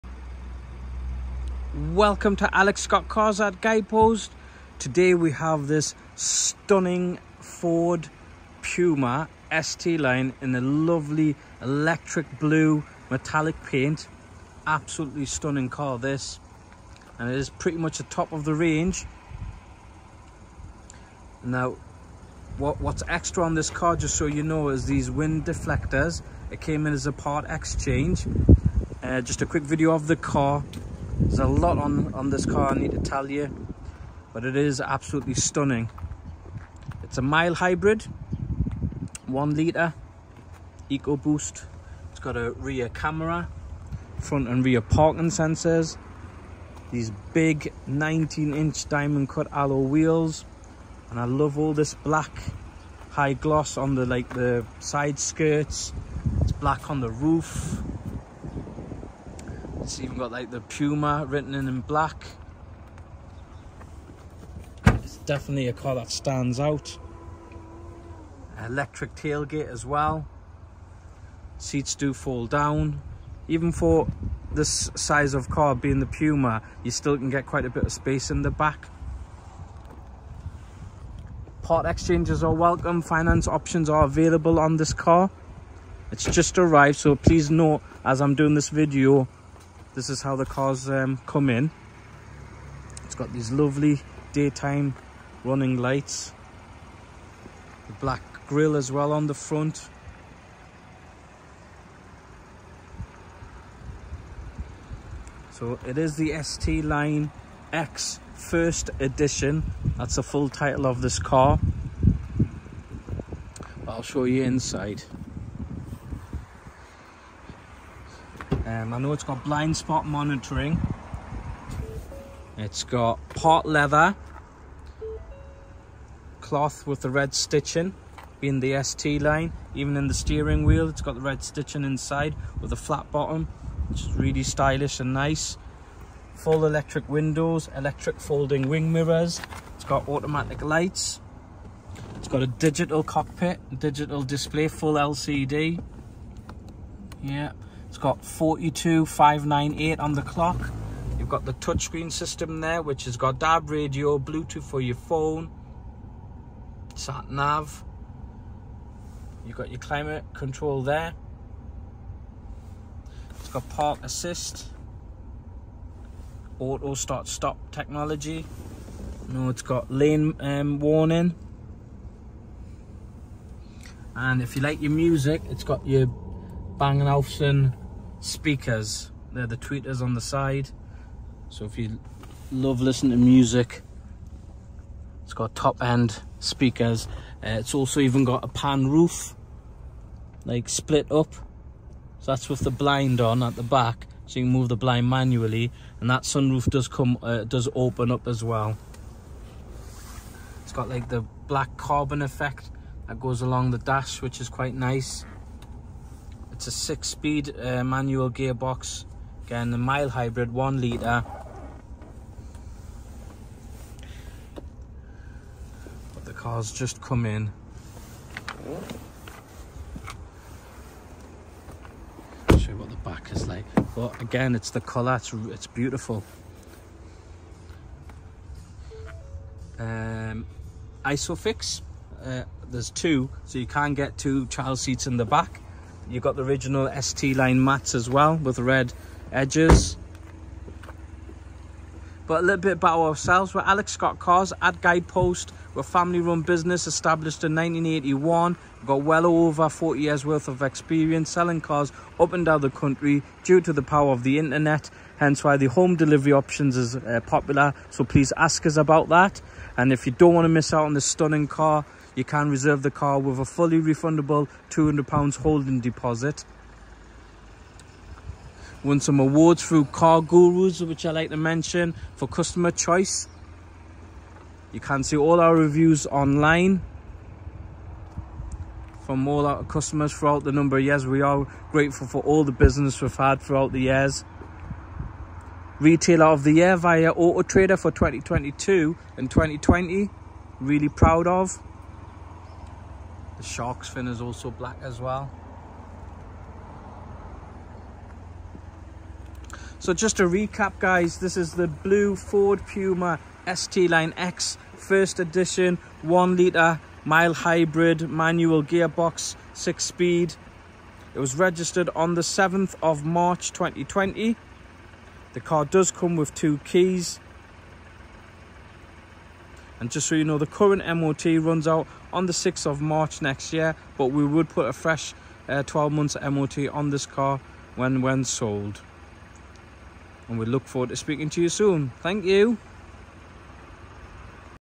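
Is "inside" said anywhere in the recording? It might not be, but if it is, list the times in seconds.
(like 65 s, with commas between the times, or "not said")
114 s, 131 s.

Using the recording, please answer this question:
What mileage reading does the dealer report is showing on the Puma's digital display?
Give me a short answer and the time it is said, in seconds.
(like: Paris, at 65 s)
42598, at 148 s.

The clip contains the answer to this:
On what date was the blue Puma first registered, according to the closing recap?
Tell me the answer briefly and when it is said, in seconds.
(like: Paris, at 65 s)
7 March 2020, at 312 s.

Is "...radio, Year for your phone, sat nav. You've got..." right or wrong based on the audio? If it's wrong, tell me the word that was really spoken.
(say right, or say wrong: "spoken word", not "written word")
wrong: "Bluetooth", not "Year".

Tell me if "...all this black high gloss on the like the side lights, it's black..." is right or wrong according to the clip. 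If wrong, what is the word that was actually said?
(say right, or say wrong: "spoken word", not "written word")
wrong: "skirts", not "lights".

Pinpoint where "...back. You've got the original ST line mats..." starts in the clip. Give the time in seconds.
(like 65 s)
235 s.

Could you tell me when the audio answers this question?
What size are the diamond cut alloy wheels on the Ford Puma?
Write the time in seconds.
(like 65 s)
47 s.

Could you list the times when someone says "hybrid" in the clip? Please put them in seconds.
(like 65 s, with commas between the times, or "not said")
37 s, 210 s, 307 s.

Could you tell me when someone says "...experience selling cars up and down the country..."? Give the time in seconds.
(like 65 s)
250 s.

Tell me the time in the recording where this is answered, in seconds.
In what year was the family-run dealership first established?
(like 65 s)
247 s.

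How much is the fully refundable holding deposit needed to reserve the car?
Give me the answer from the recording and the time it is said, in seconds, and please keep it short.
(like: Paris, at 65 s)
200 pounds, at 264 s.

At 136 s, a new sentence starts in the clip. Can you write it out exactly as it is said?
Full electric windows, electric folding wing mirrors, it's got automatic lights, it's got a digital cockpit, digital display, full LCD.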